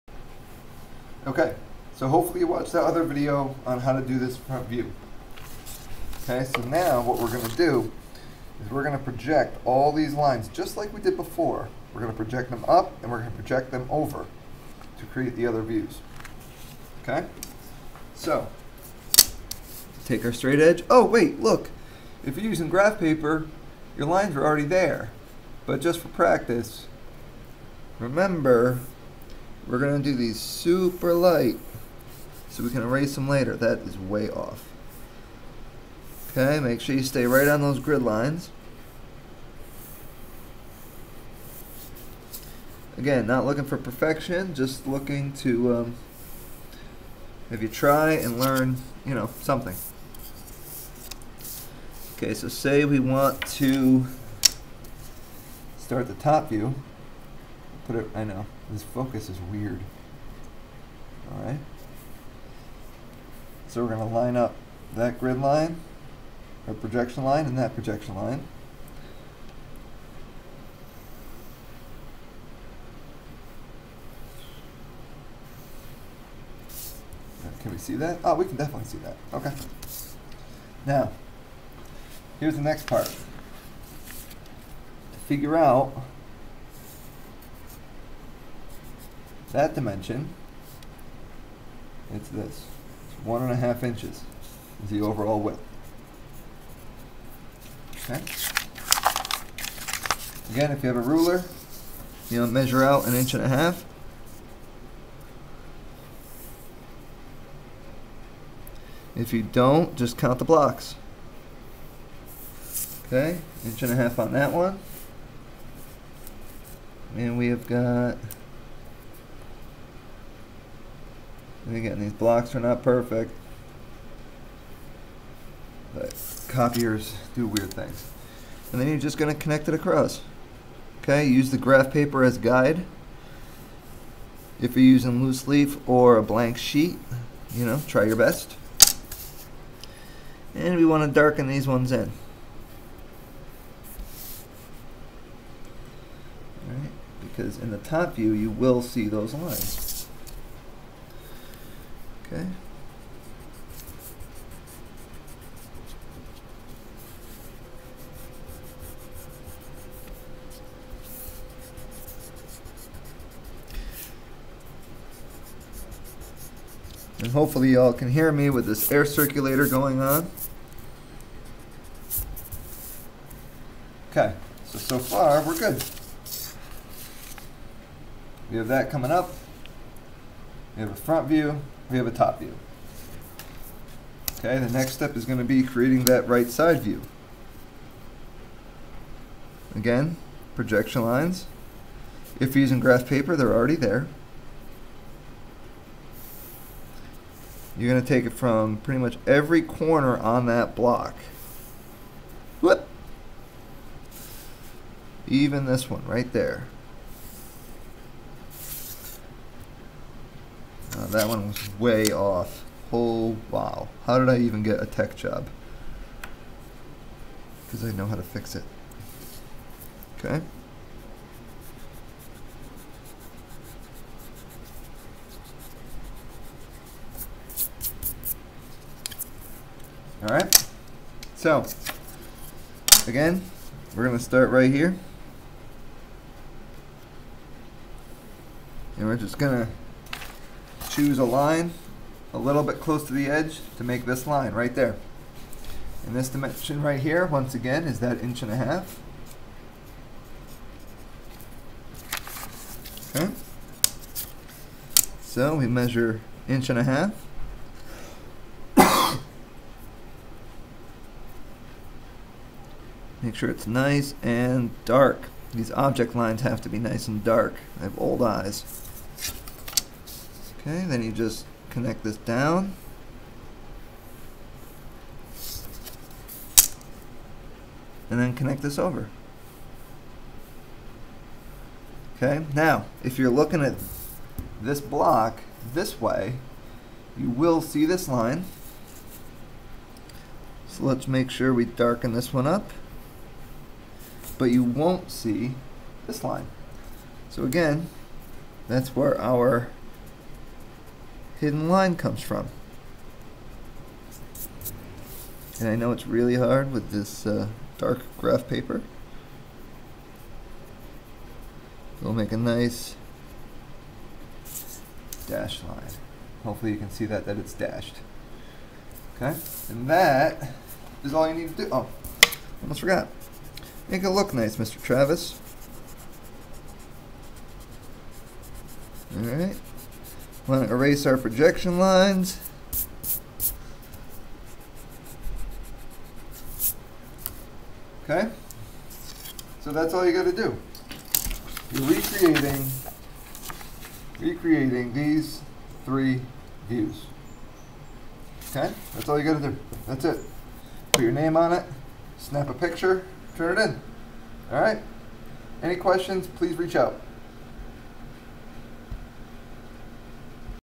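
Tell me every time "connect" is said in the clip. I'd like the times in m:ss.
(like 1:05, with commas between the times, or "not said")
2:09, 4:31, 4:38.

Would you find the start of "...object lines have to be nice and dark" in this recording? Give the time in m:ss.
4:25.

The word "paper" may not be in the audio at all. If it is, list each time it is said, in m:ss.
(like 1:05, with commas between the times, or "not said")
0:22, 2:11, 3:13, 5:08.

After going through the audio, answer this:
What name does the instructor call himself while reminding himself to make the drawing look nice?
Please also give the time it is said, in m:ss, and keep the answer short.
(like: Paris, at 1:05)
Mr. Travis, at 5:24.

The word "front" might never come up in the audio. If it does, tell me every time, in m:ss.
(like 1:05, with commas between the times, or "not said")
0:04, 3:00.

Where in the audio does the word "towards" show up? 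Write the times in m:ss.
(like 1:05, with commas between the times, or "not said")
not said.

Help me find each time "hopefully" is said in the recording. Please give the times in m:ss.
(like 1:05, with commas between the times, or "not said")
0:02, 2:47, 5:16.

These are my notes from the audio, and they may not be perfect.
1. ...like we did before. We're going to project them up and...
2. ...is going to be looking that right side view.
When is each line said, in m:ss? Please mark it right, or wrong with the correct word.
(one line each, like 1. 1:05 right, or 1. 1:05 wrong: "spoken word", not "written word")
1. 0:10 right
2. 3:05 wrong: "creating", not "looking".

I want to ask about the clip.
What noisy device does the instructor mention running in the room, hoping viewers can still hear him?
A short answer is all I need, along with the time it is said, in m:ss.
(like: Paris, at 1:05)
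air circulator, at 2:48.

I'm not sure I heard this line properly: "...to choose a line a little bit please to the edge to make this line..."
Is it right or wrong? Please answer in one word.
wrong.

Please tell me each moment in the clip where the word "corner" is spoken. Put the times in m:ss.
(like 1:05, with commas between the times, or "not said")
3:19.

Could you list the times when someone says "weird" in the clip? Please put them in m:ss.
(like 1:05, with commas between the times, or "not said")
0:59, 2:07.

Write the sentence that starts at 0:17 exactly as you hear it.
Okay, so take our straight edge.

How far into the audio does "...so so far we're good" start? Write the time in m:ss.
2:54.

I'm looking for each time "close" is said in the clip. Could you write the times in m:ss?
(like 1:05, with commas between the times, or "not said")
4:02.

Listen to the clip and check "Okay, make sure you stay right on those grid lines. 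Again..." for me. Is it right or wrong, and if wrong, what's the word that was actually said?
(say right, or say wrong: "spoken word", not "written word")
right.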